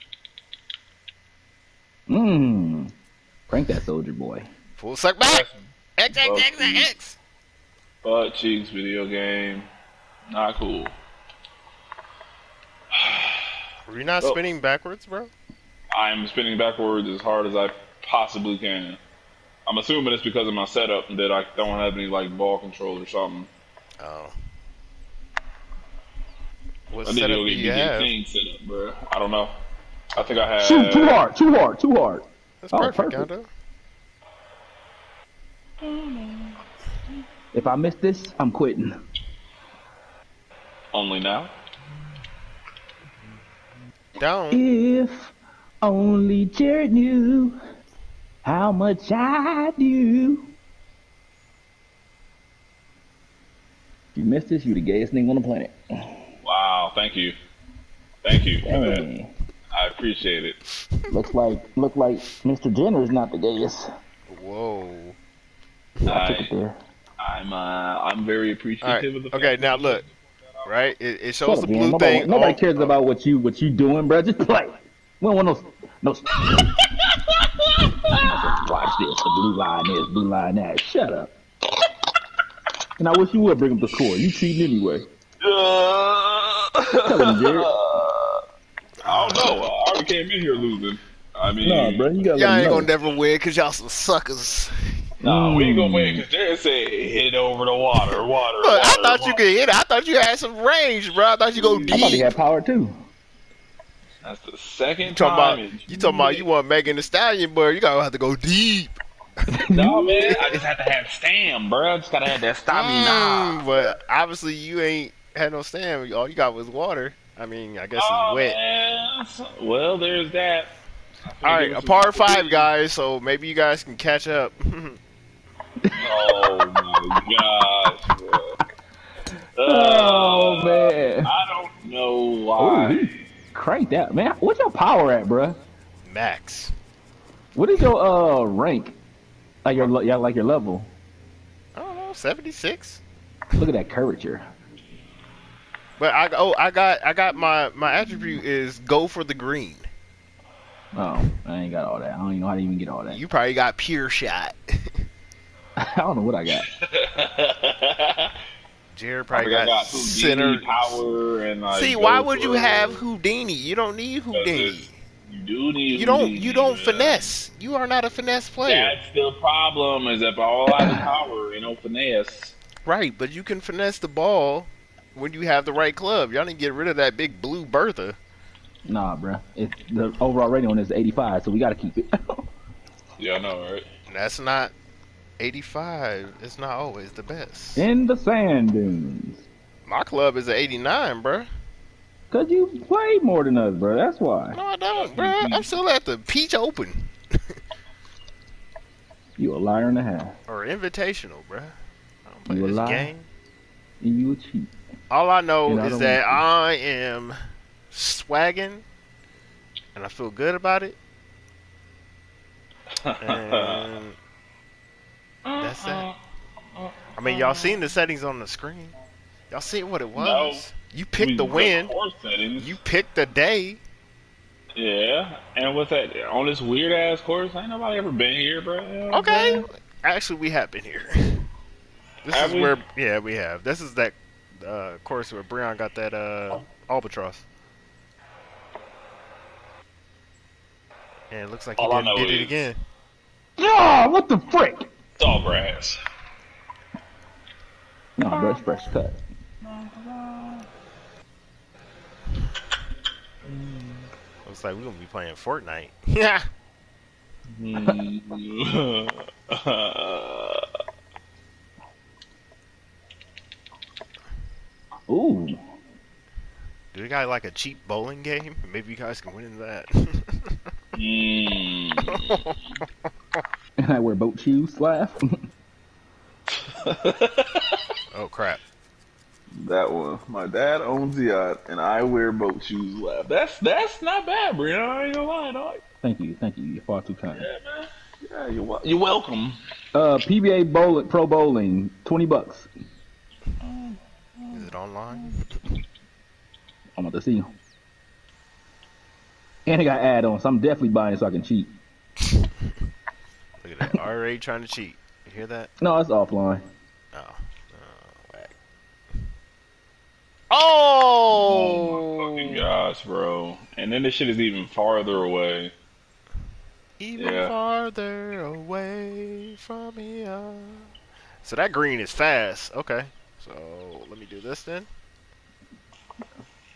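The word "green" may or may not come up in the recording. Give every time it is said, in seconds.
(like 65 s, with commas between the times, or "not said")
149 s, 321 s.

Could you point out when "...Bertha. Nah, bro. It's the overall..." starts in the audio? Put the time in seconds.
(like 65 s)
177 s.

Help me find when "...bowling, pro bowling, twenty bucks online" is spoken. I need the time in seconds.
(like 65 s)
290 s.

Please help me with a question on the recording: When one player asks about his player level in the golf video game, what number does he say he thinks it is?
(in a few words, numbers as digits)
76.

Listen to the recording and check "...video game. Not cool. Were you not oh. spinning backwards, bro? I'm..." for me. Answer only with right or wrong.
right.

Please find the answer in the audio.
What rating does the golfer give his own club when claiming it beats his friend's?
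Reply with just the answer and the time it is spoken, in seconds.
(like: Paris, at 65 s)
89, at 190 s.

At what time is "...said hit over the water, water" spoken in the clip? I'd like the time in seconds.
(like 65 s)
96 s.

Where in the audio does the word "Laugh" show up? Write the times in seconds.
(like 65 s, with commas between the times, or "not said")
274 s, 283 s.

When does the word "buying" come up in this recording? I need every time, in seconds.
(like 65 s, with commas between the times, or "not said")
300 s.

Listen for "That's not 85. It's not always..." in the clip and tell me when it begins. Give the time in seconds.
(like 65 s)
184 s.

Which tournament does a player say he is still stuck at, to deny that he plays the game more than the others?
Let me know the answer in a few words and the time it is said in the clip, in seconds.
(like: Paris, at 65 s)
Peach Open, at 196 s.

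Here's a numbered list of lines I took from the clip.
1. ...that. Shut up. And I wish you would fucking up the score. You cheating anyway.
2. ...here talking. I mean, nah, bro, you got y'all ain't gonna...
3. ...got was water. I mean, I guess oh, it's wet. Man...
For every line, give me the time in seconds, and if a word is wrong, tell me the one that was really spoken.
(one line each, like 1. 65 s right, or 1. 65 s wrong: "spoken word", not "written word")
1. 80 s wrong: "bring", not "fucking"
2. 90 s wrong: "losing", not "talking"
3. 116 s right.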